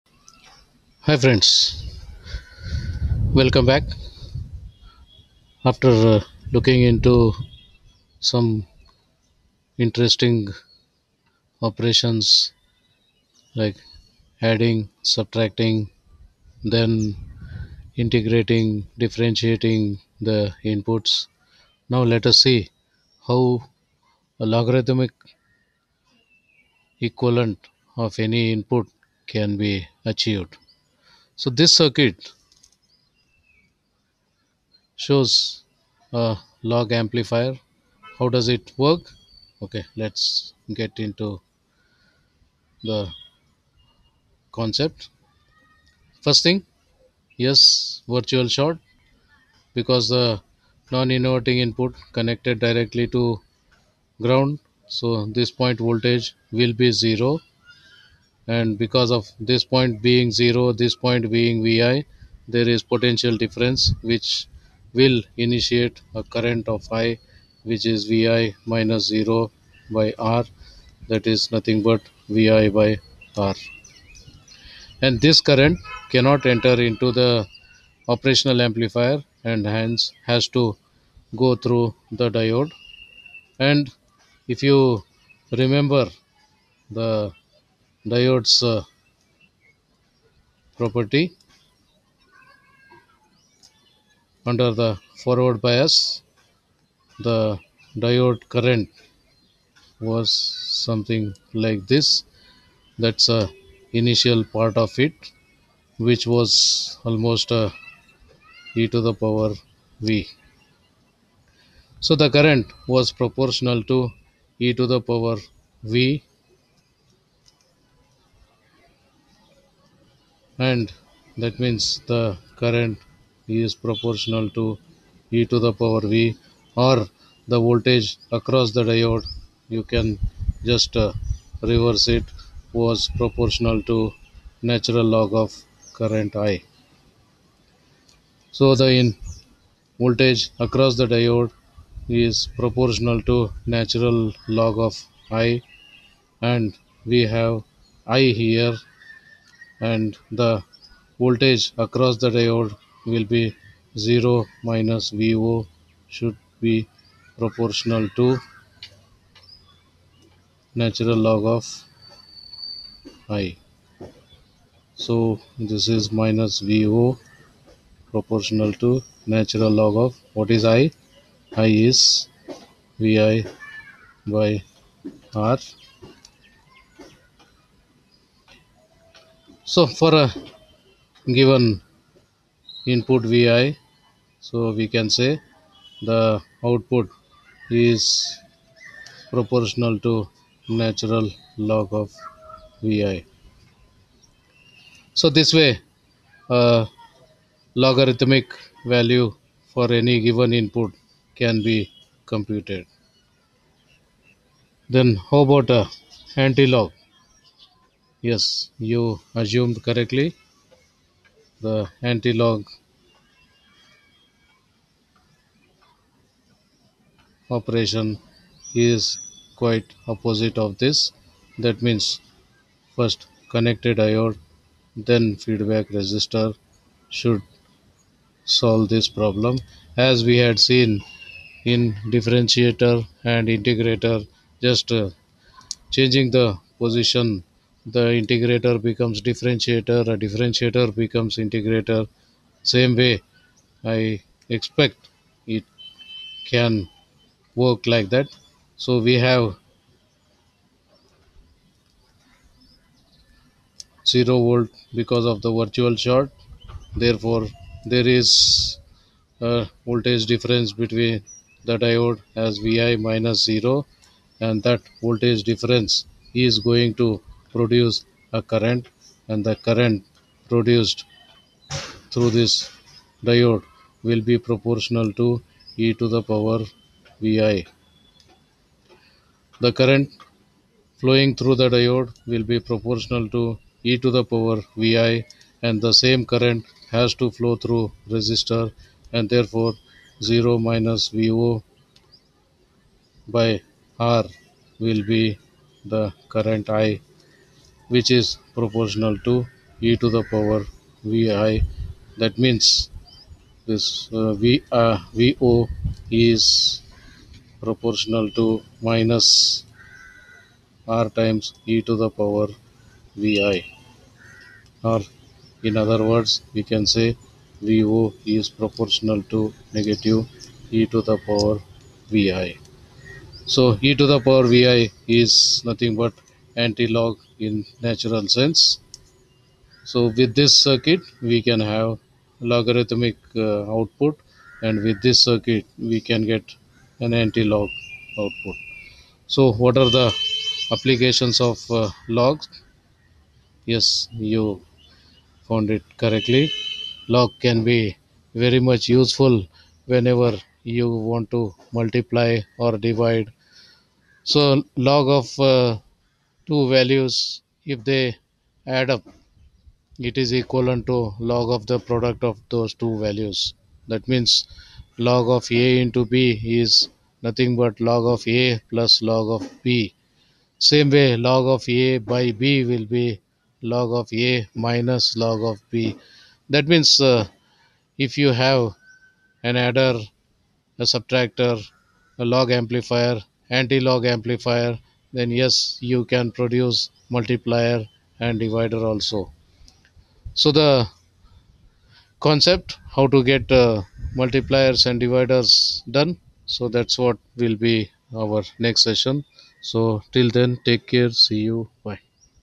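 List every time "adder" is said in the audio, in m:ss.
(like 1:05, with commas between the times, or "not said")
6:19.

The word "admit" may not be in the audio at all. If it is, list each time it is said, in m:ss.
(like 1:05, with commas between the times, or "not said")
not said.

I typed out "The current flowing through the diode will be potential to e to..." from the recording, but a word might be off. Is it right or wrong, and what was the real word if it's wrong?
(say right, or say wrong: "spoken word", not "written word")
wrong: "proportional", not "potential".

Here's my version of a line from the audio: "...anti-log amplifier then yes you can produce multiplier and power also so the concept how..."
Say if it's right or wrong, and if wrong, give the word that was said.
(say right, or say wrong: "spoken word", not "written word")
wrong: "divider", not "power".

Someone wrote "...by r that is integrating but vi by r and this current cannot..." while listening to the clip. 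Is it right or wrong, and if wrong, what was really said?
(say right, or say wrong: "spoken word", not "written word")
wrong: "nothing", not "integrating".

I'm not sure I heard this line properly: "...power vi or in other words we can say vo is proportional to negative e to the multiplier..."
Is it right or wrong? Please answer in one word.
wrong.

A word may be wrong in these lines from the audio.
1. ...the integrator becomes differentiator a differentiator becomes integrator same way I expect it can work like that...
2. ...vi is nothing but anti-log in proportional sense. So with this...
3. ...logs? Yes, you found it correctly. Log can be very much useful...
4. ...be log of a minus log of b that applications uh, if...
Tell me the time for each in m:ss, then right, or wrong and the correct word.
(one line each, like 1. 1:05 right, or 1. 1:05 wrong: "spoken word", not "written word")
1. 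3:57 right
2. 5:24 wrong: "natural", not "proportional"
3. 5:42 right
4. 6:12 wrong: "means", not "applications".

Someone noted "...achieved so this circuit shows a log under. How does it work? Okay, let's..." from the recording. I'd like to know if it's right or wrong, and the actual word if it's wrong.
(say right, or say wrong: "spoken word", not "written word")
wrong: "amplifier", not "under".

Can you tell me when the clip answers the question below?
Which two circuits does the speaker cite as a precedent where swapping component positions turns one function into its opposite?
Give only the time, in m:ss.
3:52.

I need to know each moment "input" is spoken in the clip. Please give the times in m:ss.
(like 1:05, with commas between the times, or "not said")
0:20, 0:28, 0:51, 3:02, 3:20.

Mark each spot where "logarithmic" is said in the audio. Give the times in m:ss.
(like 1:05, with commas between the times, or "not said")
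0:24, 3:17, 5:32.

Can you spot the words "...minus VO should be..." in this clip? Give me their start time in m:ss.
2:34.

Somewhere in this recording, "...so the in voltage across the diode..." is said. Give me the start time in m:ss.
2:18.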